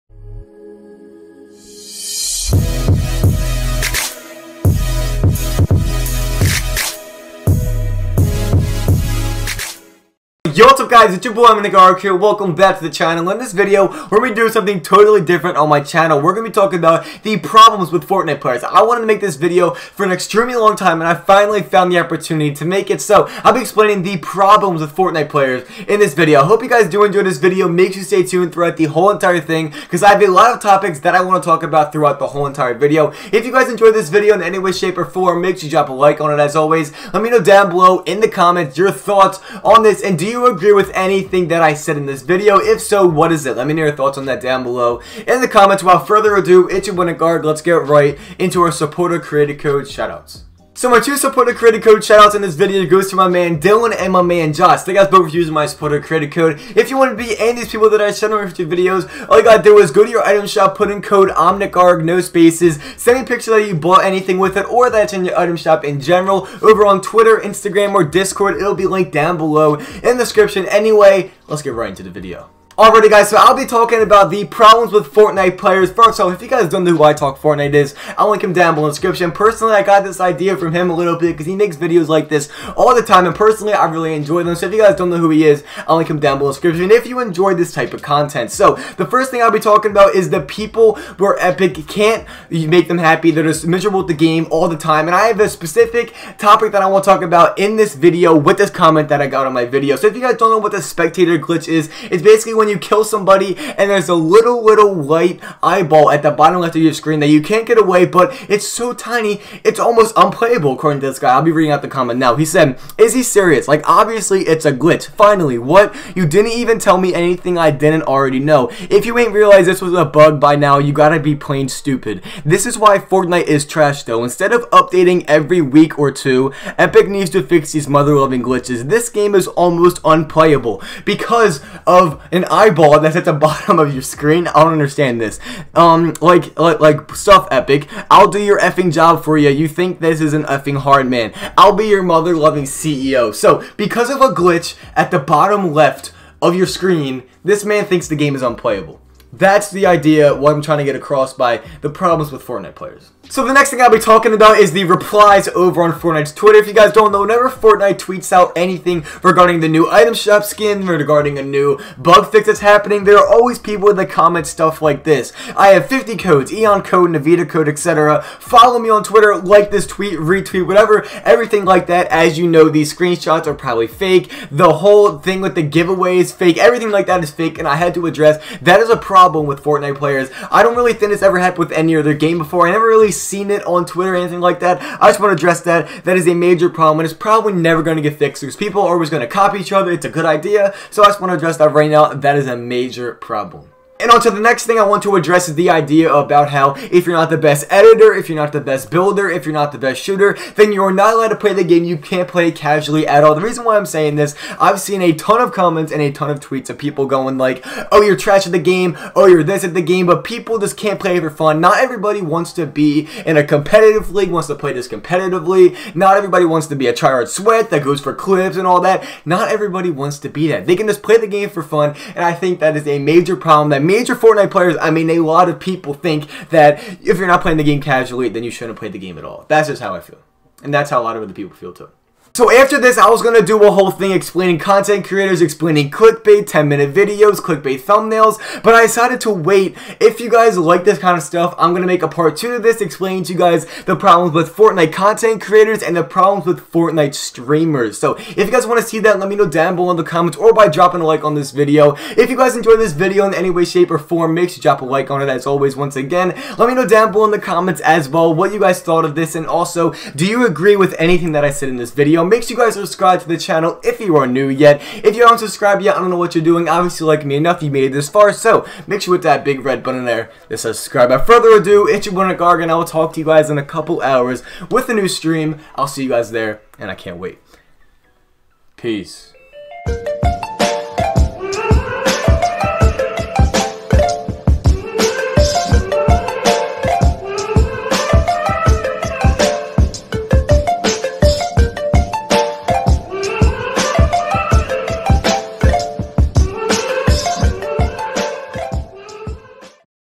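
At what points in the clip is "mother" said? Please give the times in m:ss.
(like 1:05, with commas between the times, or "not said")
2:07, 2:22.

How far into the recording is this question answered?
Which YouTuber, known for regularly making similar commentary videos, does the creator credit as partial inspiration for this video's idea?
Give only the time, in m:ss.
1:17.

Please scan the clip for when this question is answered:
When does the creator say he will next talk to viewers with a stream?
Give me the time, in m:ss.
4:33.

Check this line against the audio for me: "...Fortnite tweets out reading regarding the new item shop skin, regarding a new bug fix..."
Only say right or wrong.
wrong.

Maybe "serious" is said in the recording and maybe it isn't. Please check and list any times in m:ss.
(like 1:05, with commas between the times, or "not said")
1:53.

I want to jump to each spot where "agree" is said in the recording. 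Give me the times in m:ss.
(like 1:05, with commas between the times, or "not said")
0:40, 4:20.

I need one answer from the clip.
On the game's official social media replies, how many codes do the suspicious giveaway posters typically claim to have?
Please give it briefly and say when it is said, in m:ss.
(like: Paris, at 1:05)
50, at 2:45.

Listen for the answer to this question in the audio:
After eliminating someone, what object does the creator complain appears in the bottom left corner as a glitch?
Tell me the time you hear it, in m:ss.
1:44.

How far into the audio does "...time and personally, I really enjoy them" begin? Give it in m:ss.
1:23.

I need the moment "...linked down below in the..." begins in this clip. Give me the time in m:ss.
1:08.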